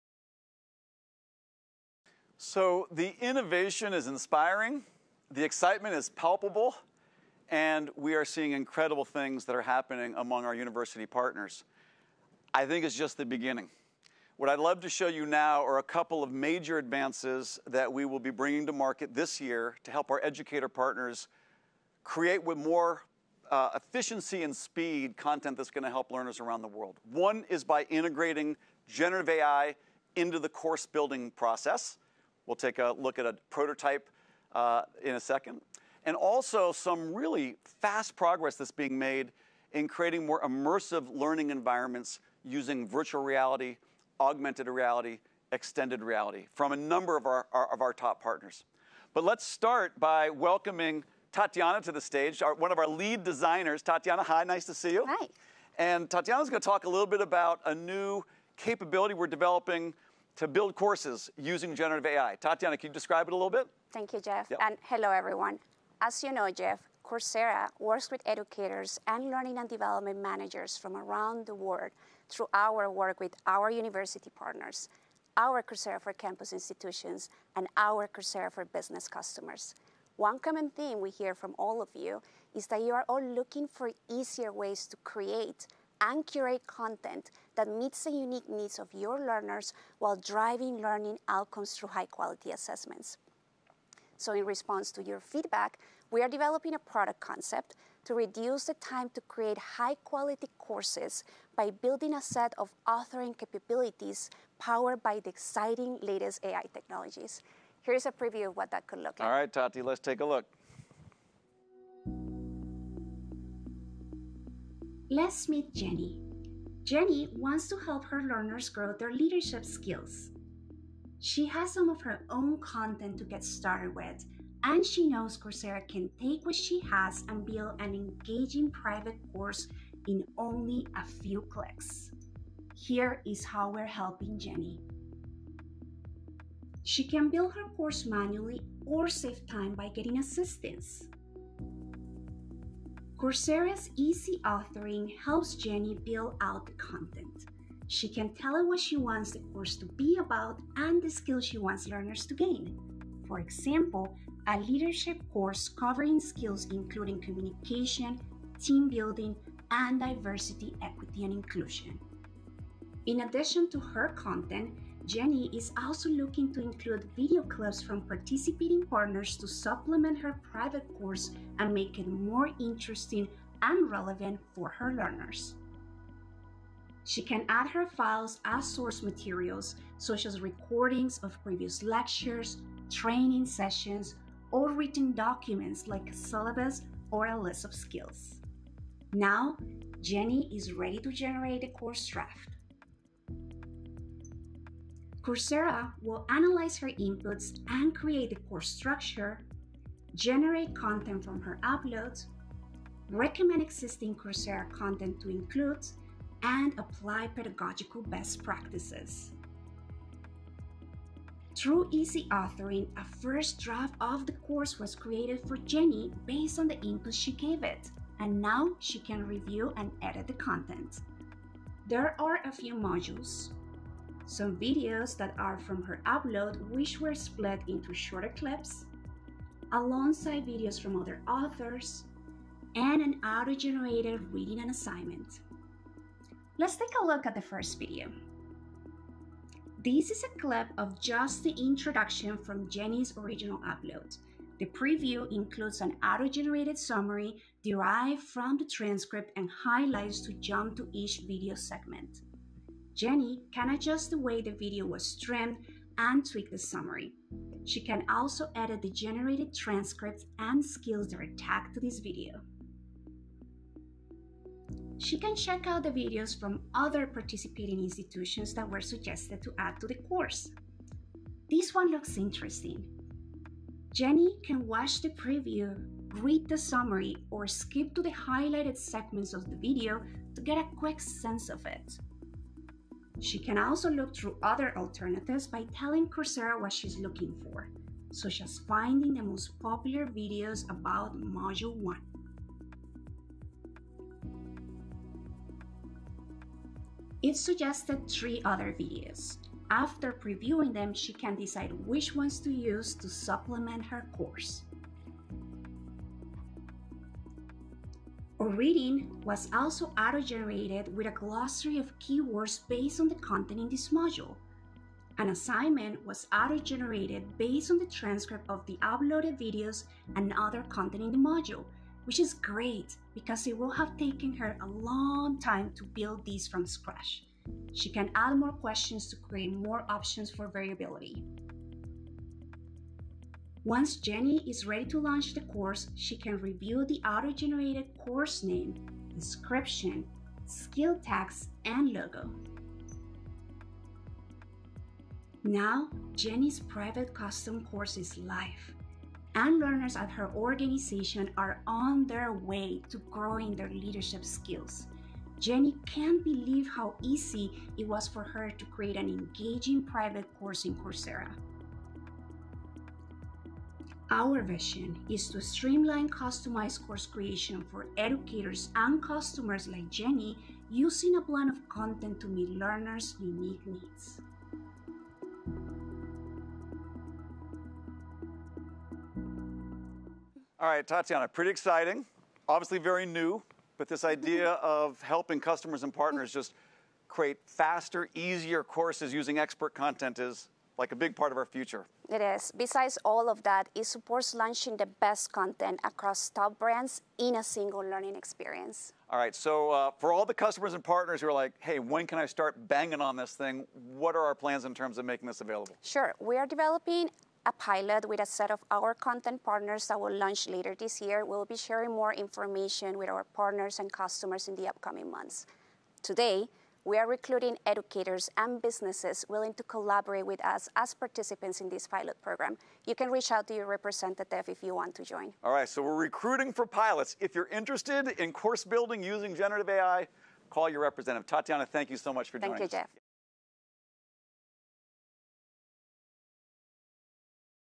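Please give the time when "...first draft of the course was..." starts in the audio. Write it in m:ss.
3:33.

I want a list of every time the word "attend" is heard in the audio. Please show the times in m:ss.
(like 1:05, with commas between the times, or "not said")
not said.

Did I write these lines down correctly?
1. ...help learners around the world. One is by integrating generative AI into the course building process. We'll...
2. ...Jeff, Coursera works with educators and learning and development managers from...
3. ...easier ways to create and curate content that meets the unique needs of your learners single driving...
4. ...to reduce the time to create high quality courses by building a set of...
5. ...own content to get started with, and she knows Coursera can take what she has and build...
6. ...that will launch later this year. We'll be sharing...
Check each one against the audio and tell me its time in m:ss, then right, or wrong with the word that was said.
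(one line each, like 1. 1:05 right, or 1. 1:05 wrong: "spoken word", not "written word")
1. 0:25 right
2. 1:06 right
3. 1:24 wrong: "while", not "single"
4. 1:38 right
5. 2:02 right
6. 6:49 right.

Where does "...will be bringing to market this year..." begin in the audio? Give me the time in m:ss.
0:18.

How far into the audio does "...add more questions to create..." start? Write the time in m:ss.
5:28.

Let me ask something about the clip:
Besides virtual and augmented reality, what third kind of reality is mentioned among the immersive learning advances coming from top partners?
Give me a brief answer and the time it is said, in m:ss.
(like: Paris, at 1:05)
extended reality, at 0:45.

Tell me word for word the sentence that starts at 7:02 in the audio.
You can reach out to your representative if you want to join.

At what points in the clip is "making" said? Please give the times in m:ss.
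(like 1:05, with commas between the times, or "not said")
6:45.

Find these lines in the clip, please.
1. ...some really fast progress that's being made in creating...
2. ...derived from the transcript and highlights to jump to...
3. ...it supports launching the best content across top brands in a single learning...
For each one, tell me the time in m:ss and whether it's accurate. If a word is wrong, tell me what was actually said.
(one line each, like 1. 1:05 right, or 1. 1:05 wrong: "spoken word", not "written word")
1. 0:36 right
2. 4:07 right
3. 6:33 right.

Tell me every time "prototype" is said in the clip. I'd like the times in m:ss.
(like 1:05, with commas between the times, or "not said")
0:33.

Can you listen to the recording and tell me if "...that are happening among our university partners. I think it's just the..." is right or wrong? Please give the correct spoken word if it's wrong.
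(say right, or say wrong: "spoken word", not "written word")
right.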